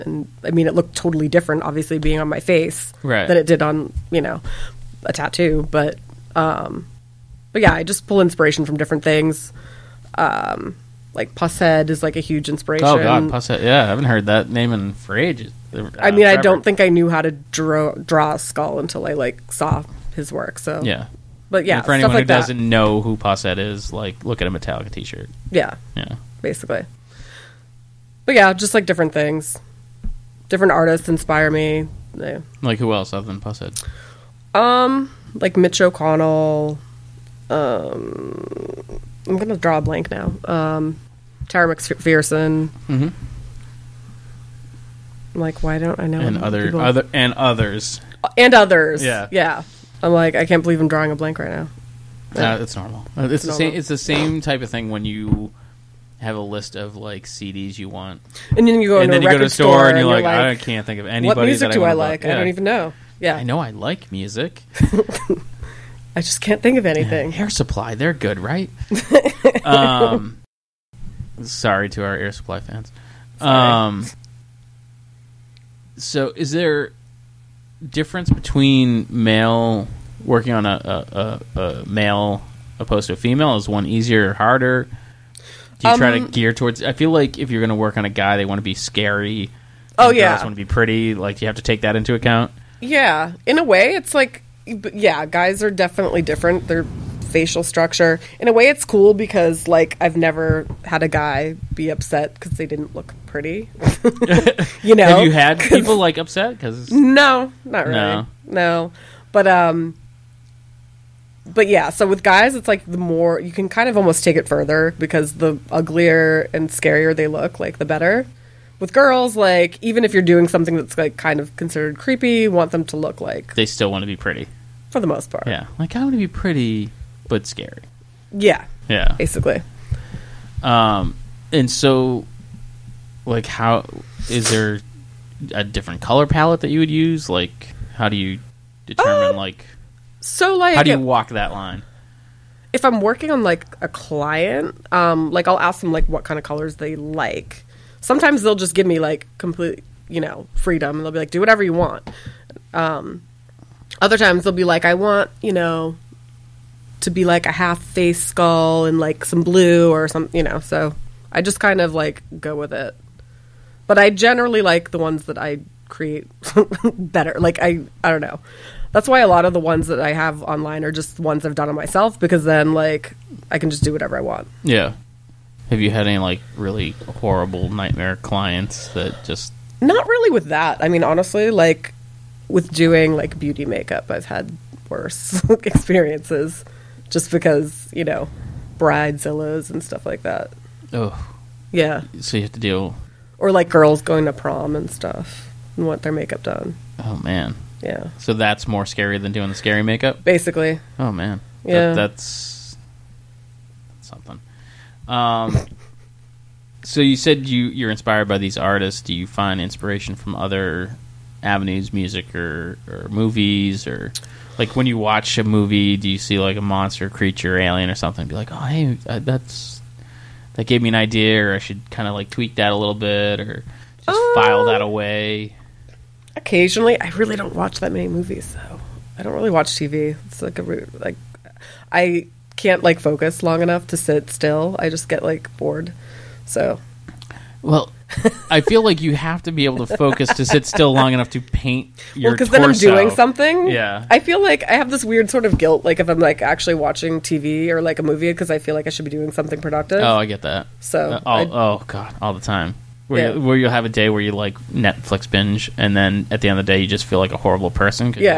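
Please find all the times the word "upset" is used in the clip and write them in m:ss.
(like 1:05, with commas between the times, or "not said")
1:41, 1:46.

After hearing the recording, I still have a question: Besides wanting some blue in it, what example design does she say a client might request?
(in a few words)
A half face skull.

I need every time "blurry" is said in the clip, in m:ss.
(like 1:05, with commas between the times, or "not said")
not said.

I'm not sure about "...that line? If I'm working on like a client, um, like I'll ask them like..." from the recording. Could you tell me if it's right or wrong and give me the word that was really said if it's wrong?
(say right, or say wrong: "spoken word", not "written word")
right.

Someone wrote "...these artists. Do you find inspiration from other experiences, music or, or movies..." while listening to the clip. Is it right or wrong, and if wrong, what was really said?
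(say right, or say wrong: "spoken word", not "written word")
wrong: "avenues", not "experiences".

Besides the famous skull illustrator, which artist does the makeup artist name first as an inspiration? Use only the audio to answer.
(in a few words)
Mitch O'Connell.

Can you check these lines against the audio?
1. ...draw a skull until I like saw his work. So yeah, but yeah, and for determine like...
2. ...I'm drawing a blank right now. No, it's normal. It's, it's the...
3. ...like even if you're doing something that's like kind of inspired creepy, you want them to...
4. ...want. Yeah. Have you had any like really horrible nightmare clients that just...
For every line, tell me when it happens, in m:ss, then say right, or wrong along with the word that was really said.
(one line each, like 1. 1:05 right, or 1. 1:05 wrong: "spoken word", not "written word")
1. 0:17 wrong: "anyone", not "determine"
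2. 0:50 right
3. 1:59 wrong: "considered", not "inspired"
4. 2:54 right.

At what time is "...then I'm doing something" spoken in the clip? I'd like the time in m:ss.
4:02.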